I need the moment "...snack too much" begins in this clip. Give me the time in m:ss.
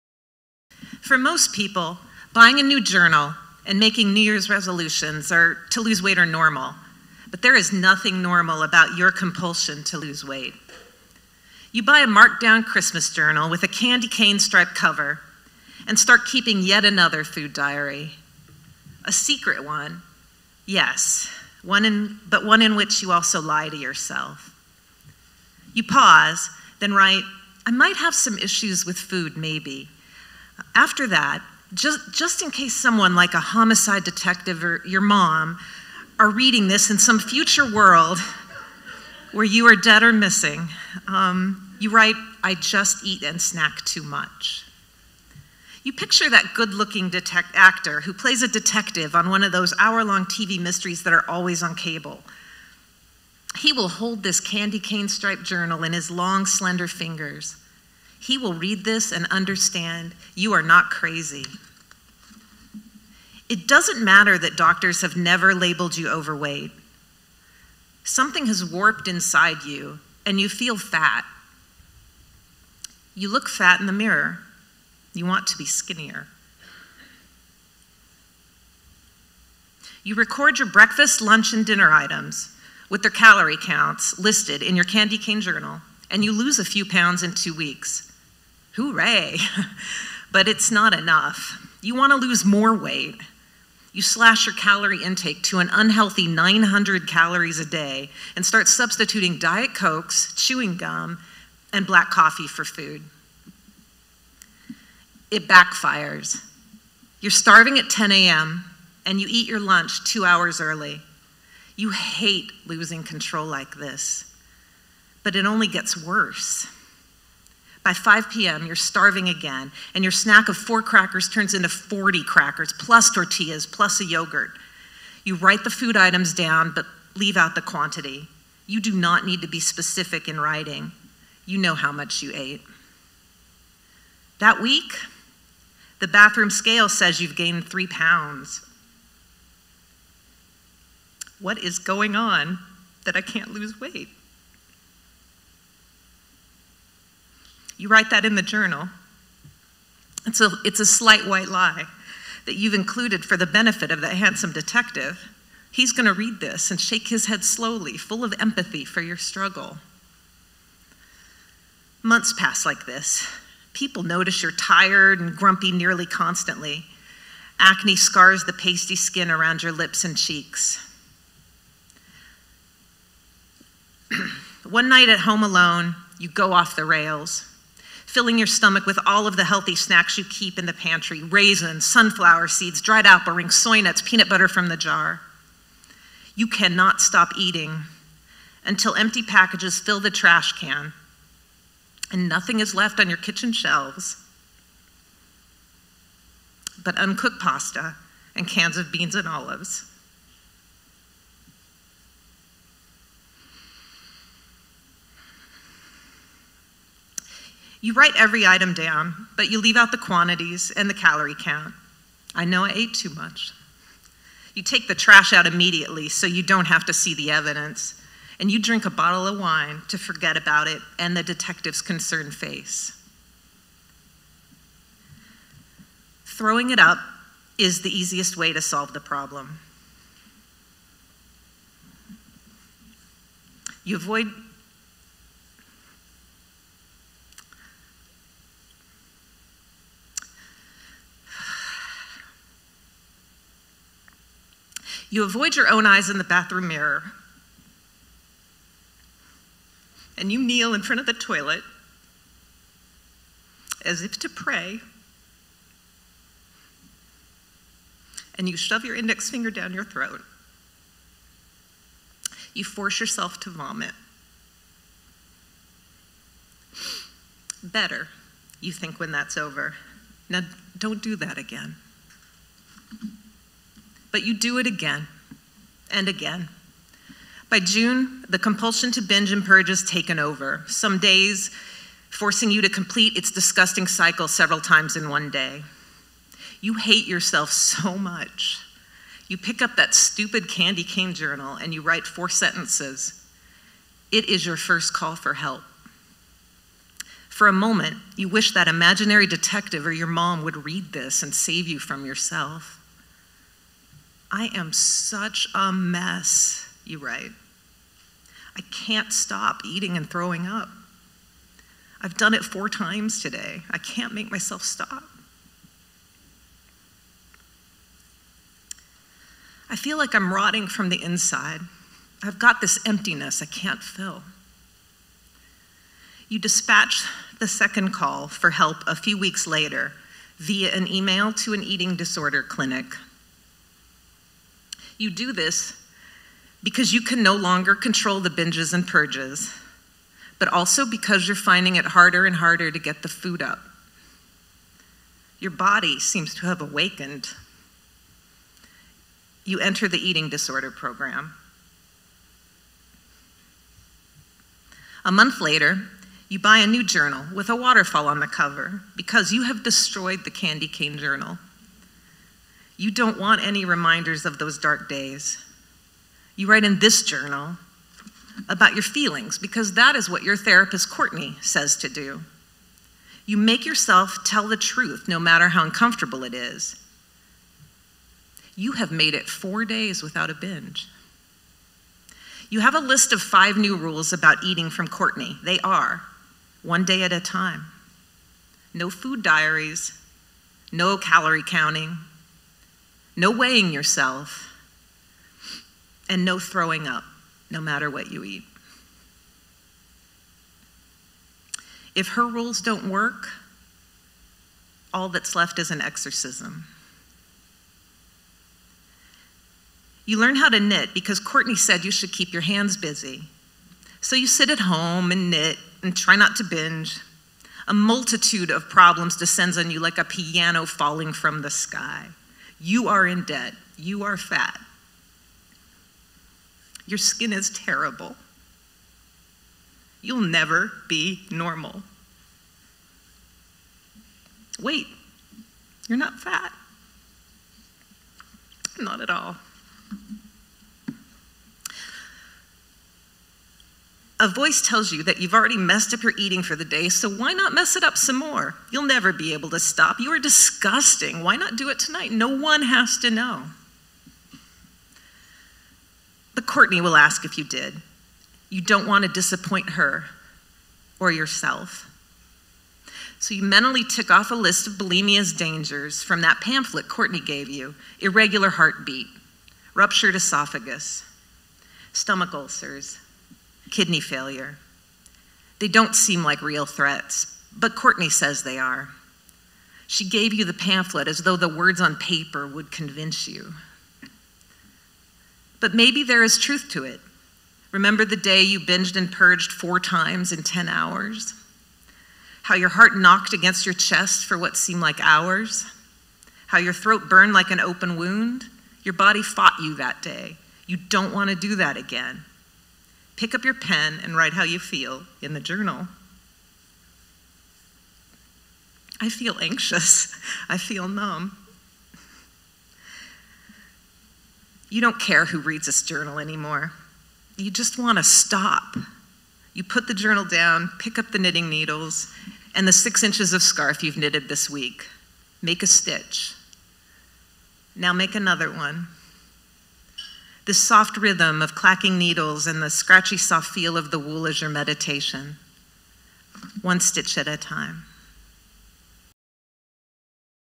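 0:43.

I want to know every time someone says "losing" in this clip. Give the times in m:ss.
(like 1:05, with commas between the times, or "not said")
1:52.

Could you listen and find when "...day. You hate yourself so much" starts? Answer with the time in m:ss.
4:45.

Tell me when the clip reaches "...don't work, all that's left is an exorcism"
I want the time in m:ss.
6:42.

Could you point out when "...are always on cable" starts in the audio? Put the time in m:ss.
0:51.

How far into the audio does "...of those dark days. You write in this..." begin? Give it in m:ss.
6:04.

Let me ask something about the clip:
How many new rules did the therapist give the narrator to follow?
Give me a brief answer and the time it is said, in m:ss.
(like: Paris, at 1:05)
5, at 6:23.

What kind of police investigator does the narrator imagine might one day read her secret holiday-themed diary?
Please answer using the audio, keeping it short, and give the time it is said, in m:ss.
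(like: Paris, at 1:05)
homicide detective, at 0:33.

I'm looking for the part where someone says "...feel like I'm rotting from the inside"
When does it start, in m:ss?
5:19.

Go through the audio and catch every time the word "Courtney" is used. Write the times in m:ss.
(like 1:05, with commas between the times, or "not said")
6:10, 6:24, 6:51, 7:36, 7:46, 7:57.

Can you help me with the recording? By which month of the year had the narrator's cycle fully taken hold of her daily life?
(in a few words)
June.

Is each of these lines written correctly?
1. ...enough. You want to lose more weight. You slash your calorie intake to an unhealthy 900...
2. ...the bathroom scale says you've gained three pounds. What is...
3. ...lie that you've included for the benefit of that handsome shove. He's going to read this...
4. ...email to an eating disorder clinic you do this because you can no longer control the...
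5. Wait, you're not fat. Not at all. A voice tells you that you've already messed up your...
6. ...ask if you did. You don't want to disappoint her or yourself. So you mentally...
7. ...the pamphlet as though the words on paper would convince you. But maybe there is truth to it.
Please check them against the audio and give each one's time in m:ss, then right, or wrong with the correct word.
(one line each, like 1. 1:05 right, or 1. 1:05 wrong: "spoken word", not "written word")
1. 1:30 right
2. 2:15 right
3. 2:31 wrong: "detective", not "shove"
4. 5:30 right
5. 7:14 right
6. 7:36 right
7. 8:00 right.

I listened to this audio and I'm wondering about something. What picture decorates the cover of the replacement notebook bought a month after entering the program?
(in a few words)
a waterfall.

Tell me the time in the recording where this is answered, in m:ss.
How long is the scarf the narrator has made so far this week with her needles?
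8:42.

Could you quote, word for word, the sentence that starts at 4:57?
For a moment, you wish that imaginary detective or your mom would read this and save you from yourself.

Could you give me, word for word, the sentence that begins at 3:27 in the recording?
You write every item down, but you leave out the quantities and the calorie count.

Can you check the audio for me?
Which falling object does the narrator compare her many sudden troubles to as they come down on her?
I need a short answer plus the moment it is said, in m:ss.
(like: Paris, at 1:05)
a piano, at 6:59.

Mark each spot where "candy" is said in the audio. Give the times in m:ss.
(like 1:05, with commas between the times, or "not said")
0:13, 0:54, 1:24, 4:50, 6:00.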